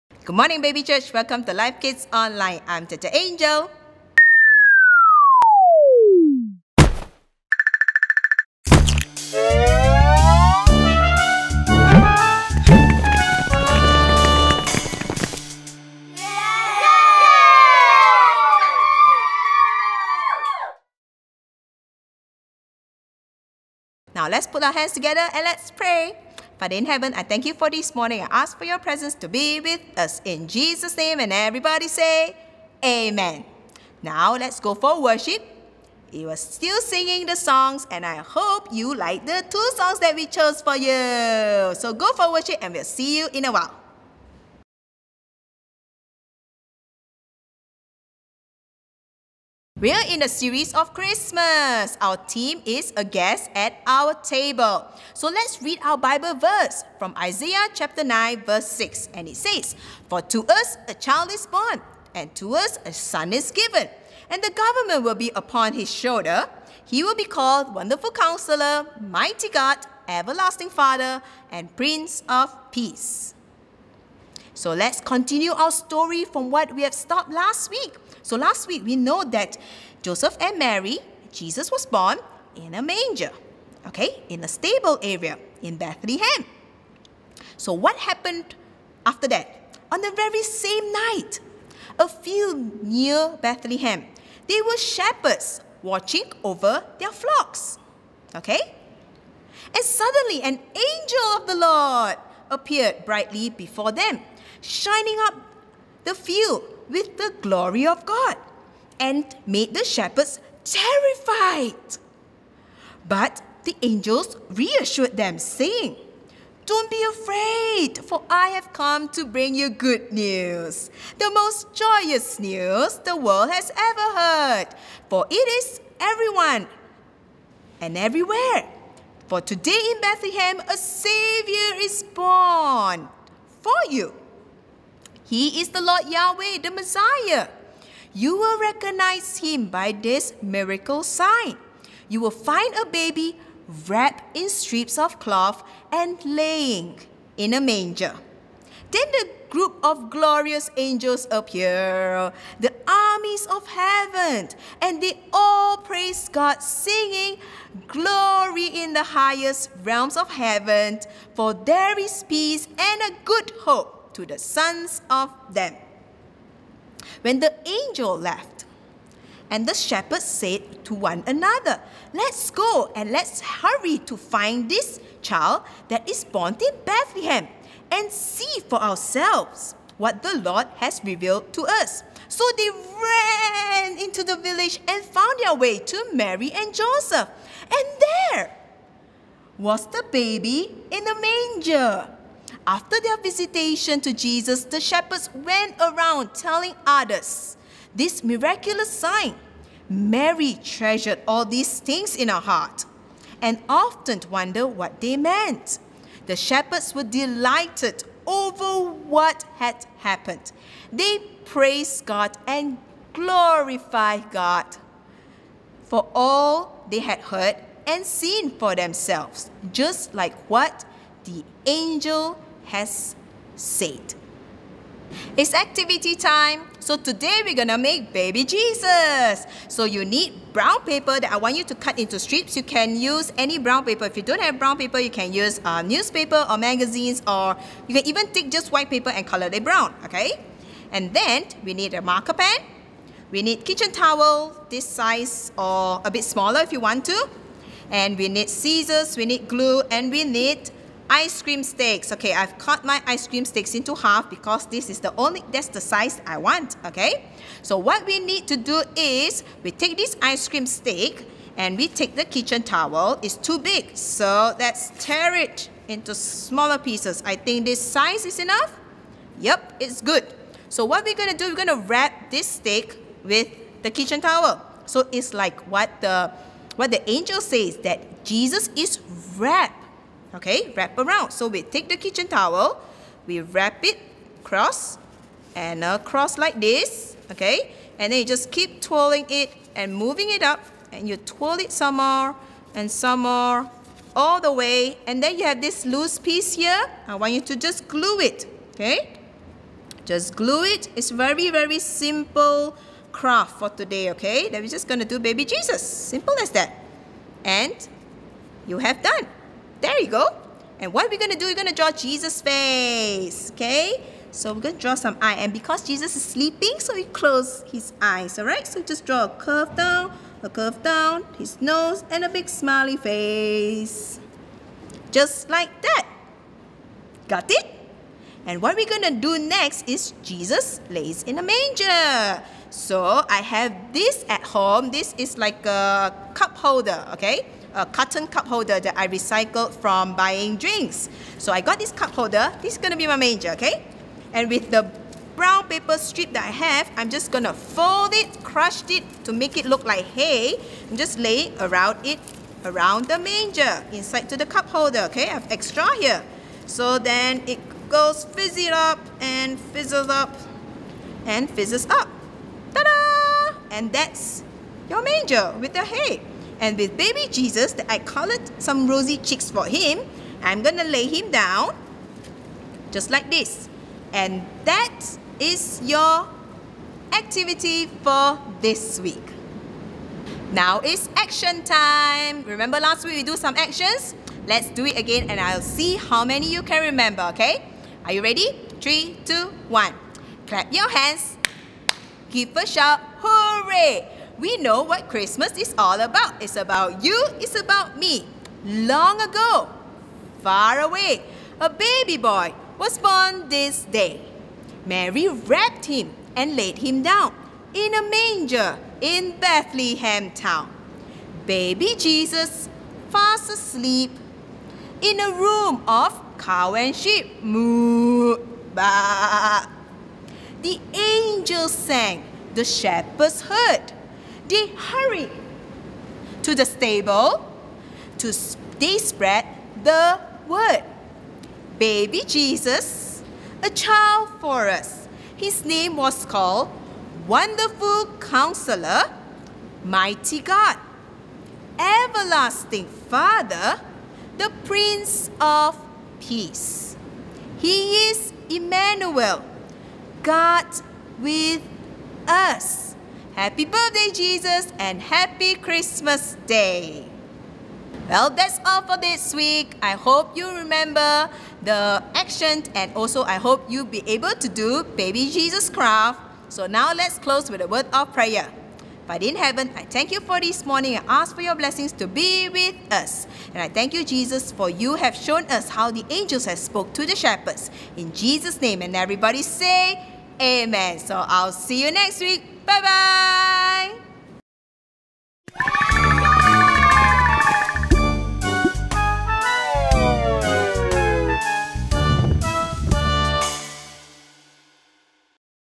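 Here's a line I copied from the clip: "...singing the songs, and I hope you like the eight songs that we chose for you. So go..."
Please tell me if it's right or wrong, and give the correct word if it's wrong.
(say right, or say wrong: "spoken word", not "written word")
wrong: "two", not "eight".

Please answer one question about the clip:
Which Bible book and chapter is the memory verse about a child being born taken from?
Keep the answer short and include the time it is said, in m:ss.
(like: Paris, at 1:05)
Isaiah chapter 9, at 0:57.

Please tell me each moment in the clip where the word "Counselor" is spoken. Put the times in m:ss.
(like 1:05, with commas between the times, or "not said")
1:08, 7:18.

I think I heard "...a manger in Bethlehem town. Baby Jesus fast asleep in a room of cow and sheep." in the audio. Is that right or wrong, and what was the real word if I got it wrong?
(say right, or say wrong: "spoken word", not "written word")
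right.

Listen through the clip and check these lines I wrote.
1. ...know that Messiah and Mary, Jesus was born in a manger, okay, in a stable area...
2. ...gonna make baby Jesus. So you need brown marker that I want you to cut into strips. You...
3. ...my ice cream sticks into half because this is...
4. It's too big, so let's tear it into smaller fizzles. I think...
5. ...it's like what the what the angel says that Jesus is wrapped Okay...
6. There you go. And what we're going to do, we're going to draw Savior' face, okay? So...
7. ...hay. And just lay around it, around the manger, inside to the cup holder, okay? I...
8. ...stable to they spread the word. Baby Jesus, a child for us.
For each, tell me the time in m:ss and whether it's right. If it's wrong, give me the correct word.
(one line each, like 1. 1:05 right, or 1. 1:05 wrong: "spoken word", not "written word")
1. 1:18 wrong: "Joseph", not "Messiah"
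2. 3:47 wrong: "paper", not "marker"
3. 4:12 right
4. 4:23 wrong: "pieces", not "fizzles"
5. 4:35 right
6. 5:09 wrong: "Jesus", not "Savior"
7. 5:50 right
8. 7:06 right.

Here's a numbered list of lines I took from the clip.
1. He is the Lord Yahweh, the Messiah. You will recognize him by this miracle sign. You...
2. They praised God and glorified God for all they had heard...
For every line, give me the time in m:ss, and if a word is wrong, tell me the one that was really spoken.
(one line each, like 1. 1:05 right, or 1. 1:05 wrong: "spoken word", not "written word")
1. 2:15 right
2. 3:30 right.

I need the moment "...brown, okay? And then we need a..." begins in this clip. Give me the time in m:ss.
3:59.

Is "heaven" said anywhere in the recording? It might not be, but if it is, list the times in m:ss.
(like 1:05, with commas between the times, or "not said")
0:26, 2:33, 2:40, 7:49.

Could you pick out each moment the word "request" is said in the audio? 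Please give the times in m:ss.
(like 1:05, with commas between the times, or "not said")
not said.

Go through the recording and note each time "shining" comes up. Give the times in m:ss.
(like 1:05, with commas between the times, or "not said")
1:44.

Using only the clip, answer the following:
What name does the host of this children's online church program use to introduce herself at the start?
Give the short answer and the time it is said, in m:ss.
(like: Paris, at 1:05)
Tata Angel, at 0:02.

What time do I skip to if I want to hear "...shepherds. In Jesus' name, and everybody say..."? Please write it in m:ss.
7:57.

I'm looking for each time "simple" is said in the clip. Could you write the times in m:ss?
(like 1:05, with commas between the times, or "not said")
5:01, 5:05.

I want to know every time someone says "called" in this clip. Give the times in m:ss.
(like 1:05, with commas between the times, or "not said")
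1:07, 7:16.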